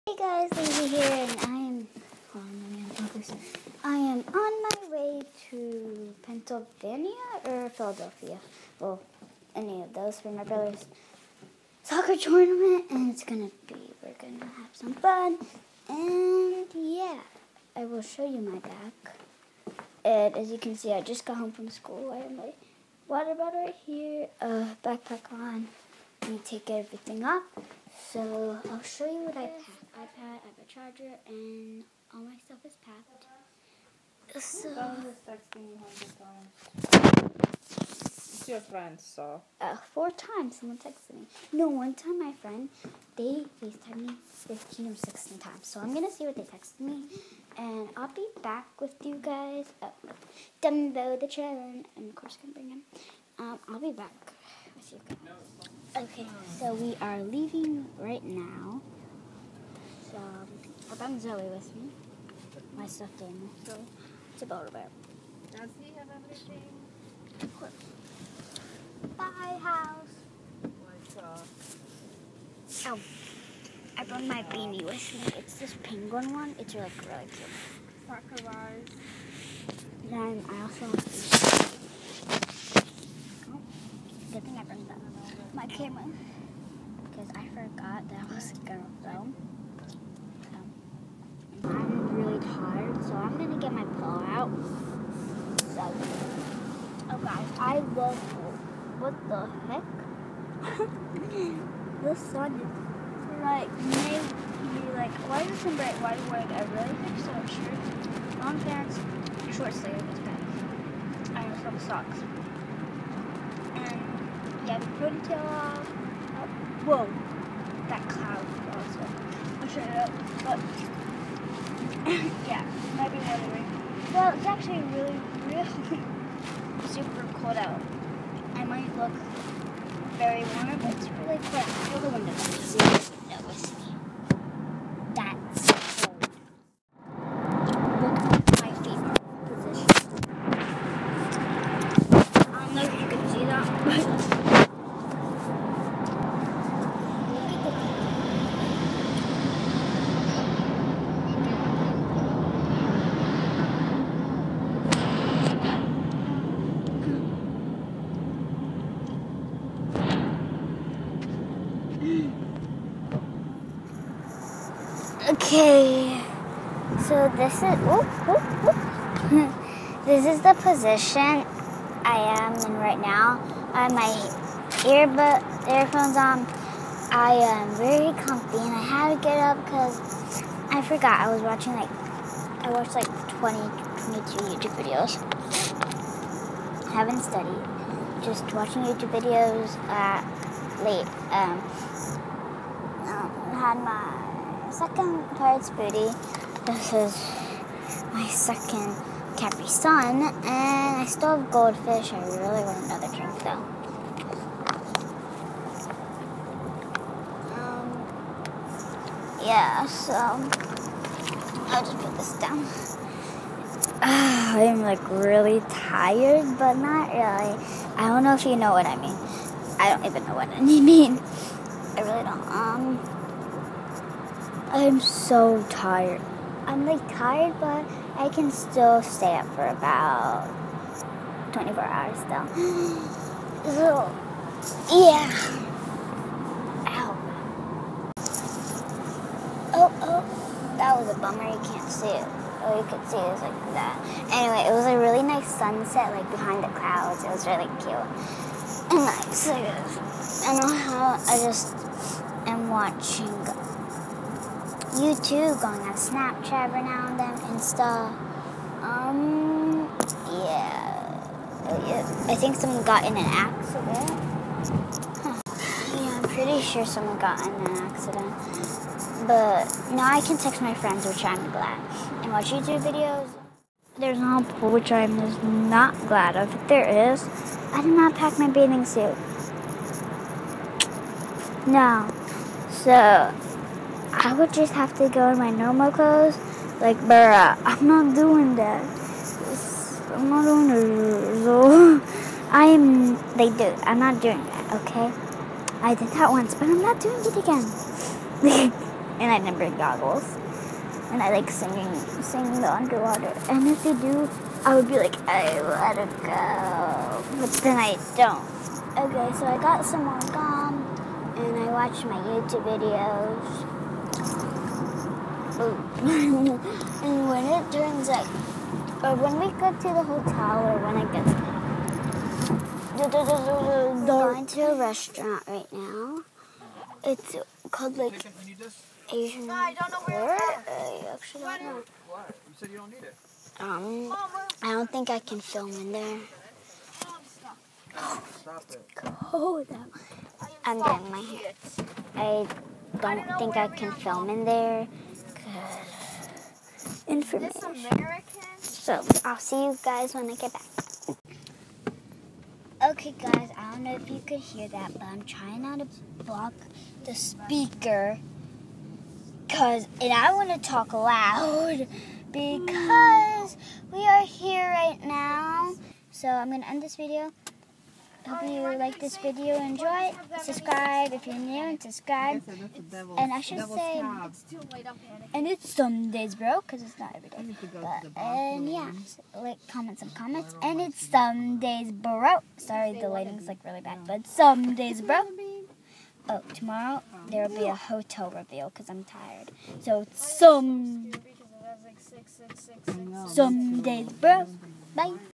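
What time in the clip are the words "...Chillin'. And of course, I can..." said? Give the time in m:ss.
0:51.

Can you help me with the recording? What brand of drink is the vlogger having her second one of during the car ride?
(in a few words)
Capri Sun.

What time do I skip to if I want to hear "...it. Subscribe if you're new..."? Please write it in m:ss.
6:10.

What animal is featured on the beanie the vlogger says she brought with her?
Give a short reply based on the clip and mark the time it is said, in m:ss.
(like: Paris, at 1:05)
Penguin, at 1:15.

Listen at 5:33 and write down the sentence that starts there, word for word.
Um, I don't think I can film in there.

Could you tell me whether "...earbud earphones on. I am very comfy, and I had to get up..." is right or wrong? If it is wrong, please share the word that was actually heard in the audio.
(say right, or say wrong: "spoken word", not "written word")
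right.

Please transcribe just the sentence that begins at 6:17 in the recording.
But, and yeah, like, comment some comments.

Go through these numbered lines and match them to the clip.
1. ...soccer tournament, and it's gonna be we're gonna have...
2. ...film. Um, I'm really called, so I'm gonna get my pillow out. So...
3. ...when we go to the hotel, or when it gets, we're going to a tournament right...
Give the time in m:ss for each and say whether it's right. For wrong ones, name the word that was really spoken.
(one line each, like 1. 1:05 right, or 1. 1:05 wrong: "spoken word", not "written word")
1. 0:11 right
2. 1:29 wrong: "tired", not "called"
3. 5:19 wrong: "restaurant", not "tournament".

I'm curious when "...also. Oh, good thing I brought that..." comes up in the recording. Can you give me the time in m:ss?
1:20.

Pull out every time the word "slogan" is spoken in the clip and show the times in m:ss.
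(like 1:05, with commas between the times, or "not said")
not said.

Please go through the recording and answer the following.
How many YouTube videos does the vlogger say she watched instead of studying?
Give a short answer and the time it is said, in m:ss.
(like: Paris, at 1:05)
22, at 3:04.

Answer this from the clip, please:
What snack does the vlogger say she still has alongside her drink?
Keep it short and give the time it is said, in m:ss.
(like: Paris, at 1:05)
Goldfish, at 3:21.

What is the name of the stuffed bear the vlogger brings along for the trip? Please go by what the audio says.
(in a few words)
Zoe.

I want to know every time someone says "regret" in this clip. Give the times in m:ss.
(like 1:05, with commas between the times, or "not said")
not said.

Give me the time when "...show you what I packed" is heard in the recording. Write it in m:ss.
0:28.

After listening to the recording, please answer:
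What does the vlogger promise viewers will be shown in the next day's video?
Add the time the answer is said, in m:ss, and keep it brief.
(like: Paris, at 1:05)
Hotel reveal, at 6:27.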